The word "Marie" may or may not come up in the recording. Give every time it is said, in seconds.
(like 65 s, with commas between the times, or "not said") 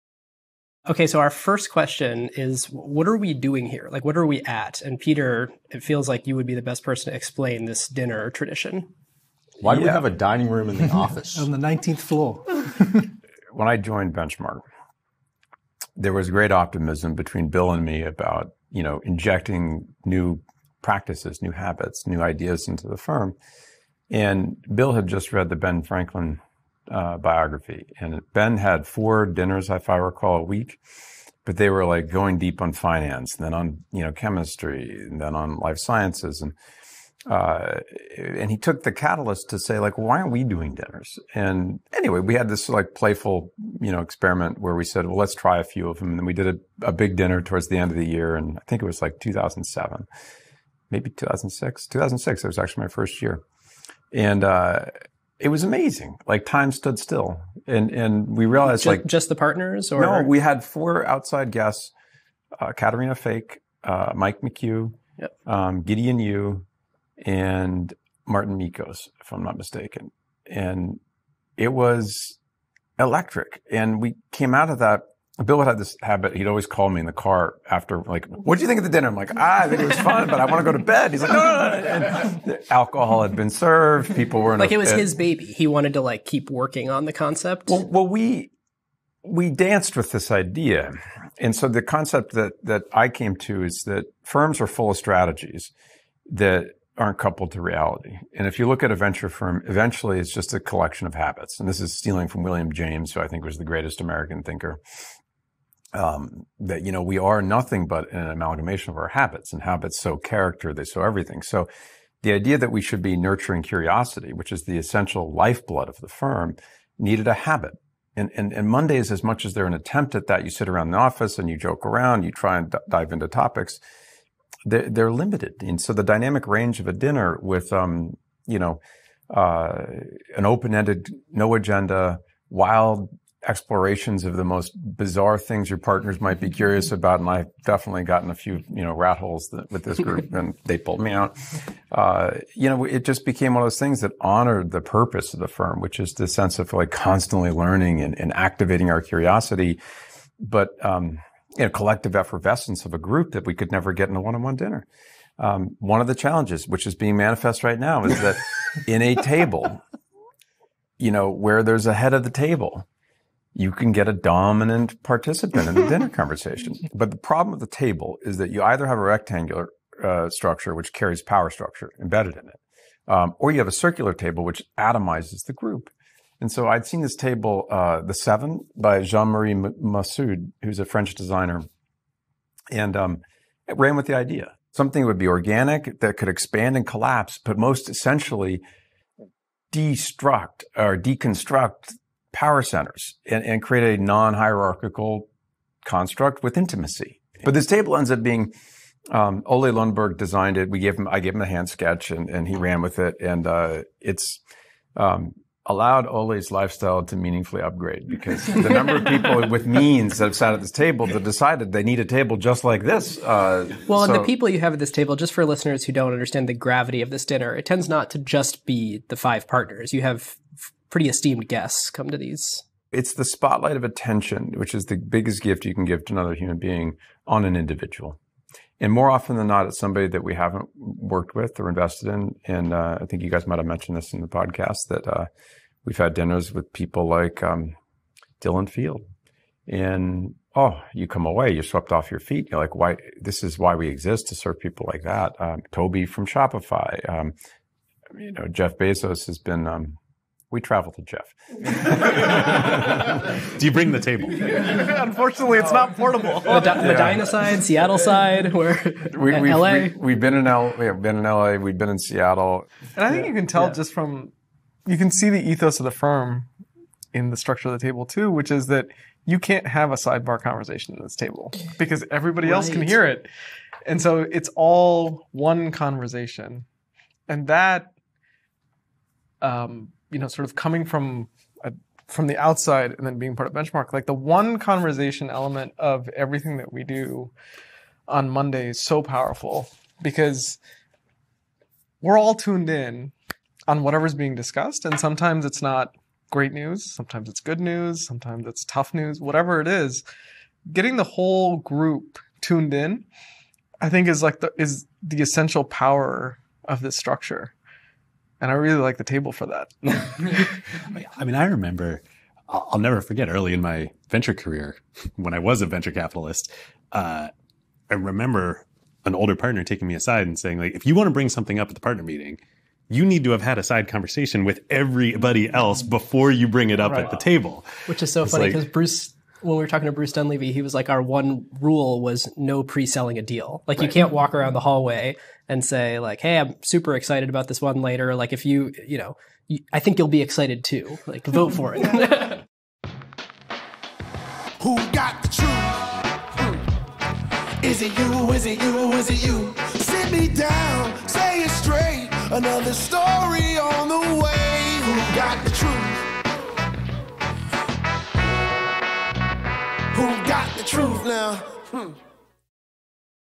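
179 s.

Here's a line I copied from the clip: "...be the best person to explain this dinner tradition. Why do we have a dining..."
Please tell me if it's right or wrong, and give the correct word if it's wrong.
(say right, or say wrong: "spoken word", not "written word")
right.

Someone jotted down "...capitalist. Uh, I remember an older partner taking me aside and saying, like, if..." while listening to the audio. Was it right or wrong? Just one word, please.
right.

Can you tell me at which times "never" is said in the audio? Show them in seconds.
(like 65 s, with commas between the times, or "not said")
153 s, 312 s.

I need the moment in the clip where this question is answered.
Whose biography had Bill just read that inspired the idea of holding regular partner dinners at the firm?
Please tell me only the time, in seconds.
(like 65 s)
25 s.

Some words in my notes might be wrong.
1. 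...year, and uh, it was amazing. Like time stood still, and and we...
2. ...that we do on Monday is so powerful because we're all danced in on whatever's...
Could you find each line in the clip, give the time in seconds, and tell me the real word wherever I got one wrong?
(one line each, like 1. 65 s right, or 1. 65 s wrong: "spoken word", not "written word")
1. 53 s right
2. 286 s wrong: "tuned", not "danced".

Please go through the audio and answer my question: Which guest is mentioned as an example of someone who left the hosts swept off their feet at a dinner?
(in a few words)
Dylan Field.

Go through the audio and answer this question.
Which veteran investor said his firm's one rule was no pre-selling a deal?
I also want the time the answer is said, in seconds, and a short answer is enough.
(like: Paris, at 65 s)
Bruce Dunlevie, at 329 s.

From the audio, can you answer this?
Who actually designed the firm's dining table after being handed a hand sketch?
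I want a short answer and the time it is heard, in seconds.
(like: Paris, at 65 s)
Ole Lundberg, at 199 s.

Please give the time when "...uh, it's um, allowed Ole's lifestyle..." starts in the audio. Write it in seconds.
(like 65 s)
203 s.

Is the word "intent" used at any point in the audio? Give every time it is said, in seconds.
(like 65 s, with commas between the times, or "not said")
not said.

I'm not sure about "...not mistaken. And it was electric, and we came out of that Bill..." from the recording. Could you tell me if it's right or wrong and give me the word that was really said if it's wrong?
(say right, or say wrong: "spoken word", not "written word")
right.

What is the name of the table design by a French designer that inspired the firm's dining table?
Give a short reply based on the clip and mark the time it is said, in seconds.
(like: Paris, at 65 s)
The Seven, at 178 s.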